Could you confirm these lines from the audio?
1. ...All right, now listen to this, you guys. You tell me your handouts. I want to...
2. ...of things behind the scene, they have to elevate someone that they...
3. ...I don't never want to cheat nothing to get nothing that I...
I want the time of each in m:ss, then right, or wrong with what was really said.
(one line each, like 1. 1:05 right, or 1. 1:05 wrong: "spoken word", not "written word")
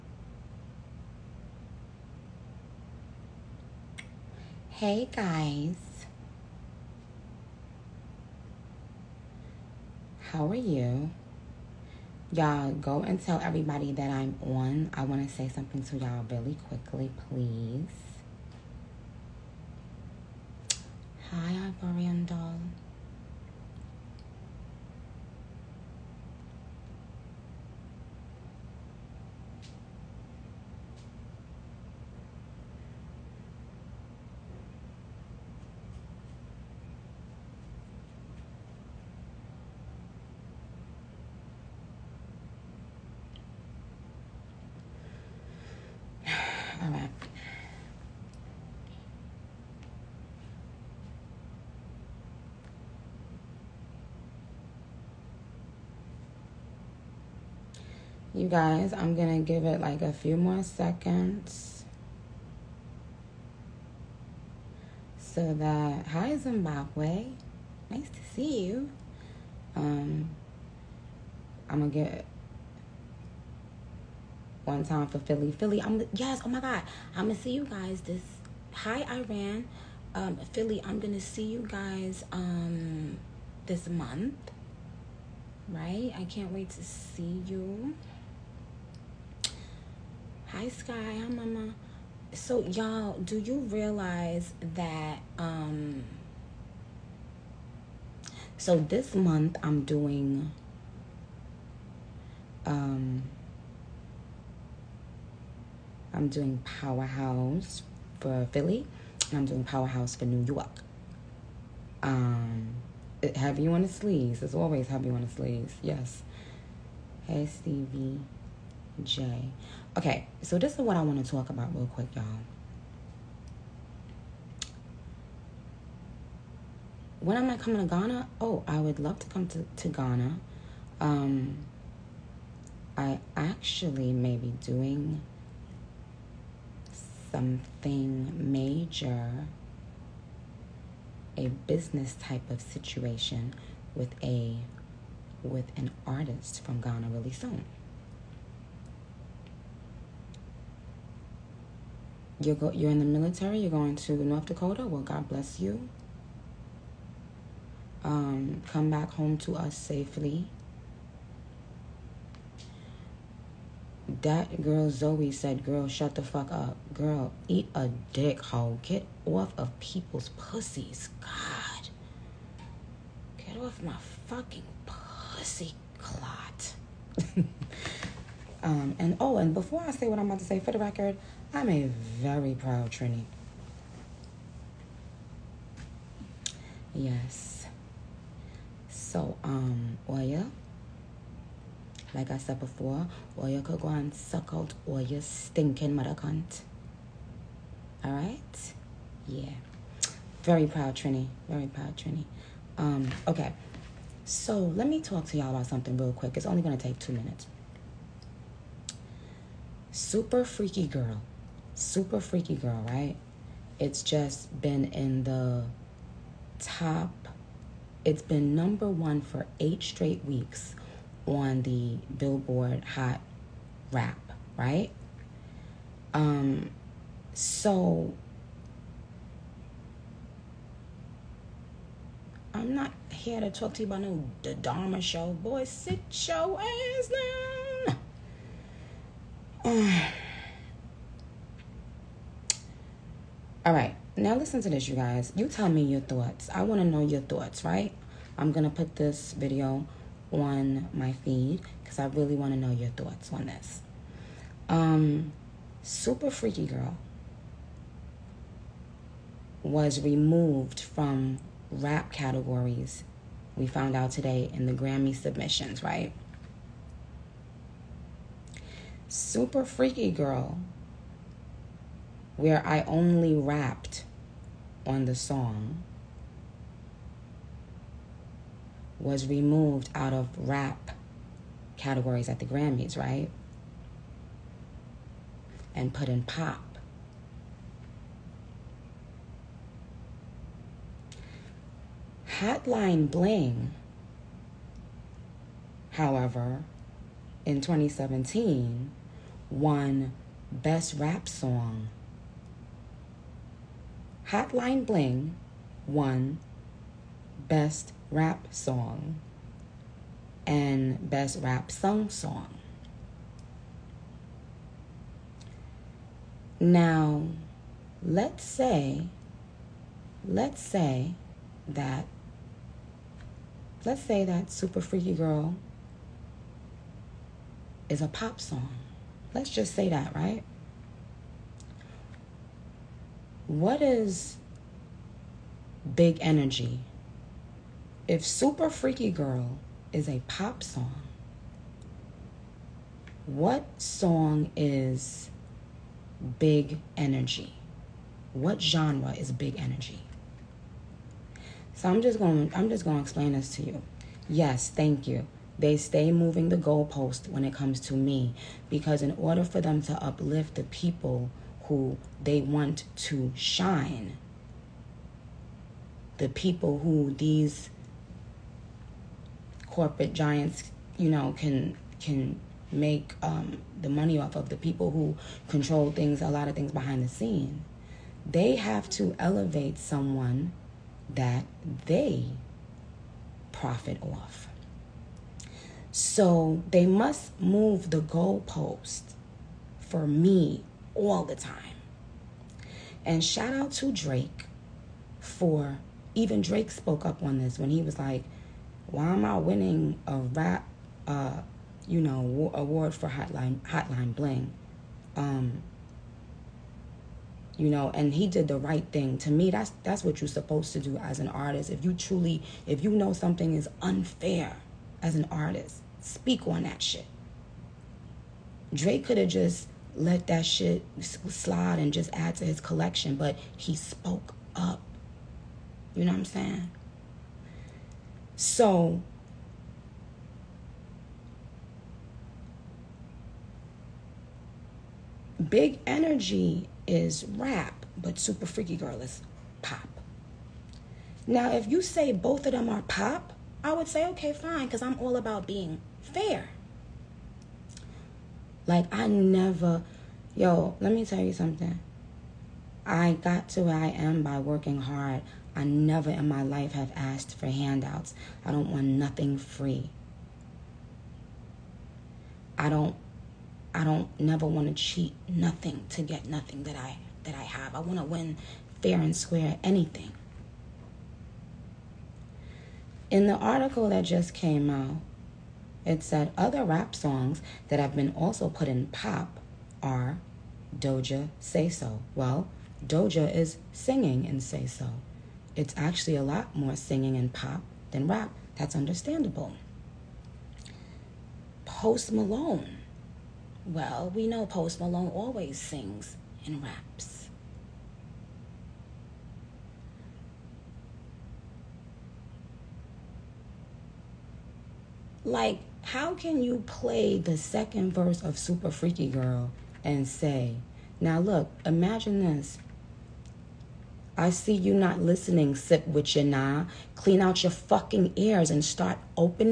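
1. 4:03 wrong: "thoughts", not "handouts"
2. 6:16 right
3. 7:43 right.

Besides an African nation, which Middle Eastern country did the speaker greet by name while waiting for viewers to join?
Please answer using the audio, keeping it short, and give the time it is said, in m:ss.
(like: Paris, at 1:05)
Iran, at 1:19.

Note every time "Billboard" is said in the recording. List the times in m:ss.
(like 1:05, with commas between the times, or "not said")
3:42.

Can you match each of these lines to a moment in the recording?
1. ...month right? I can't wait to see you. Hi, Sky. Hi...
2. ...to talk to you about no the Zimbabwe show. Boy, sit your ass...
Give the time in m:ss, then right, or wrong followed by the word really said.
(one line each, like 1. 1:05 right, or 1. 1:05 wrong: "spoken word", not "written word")
1. 1:23 right
2. 3:53 wrong: "Dharma", not "Zimbabwe".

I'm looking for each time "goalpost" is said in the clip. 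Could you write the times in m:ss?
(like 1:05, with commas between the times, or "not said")
5:56, 6:28.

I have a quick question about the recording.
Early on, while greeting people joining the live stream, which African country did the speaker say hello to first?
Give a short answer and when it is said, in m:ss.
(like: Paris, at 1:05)
Zimbabwe, at 1:06.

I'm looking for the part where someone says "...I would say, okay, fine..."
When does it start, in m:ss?
7:23.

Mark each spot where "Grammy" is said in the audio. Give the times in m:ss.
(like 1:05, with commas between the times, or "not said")
4:24, 4:42.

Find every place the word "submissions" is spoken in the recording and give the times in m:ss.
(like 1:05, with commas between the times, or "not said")
4:25.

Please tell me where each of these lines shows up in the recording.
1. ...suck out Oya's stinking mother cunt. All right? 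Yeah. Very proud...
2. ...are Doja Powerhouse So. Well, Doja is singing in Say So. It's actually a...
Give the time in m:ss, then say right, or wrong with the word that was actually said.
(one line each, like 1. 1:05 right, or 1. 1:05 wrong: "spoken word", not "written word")
1. 3:14 right
2. 7:59 wrong: "Say", not "Powerhouse".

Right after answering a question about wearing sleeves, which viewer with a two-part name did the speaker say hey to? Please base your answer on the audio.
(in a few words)
Stevie J.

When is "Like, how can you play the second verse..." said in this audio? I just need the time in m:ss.
8:25.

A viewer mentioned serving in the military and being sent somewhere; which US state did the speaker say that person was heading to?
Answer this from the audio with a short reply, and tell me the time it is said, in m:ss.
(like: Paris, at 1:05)
North Dakota, at 2:34.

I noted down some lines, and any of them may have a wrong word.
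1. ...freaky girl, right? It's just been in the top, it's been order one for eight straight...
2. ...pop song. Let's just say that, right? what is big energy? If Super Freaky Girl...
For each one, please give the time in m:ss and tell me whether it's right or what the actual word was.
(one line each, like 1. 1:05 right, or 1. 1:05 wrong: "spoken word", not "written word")
1. 3:32 wrong: "number", not "order"
2. 5:28 right.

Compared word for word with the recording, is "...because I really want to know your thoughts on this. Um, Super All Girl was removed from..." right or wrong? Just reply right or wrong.
wrong.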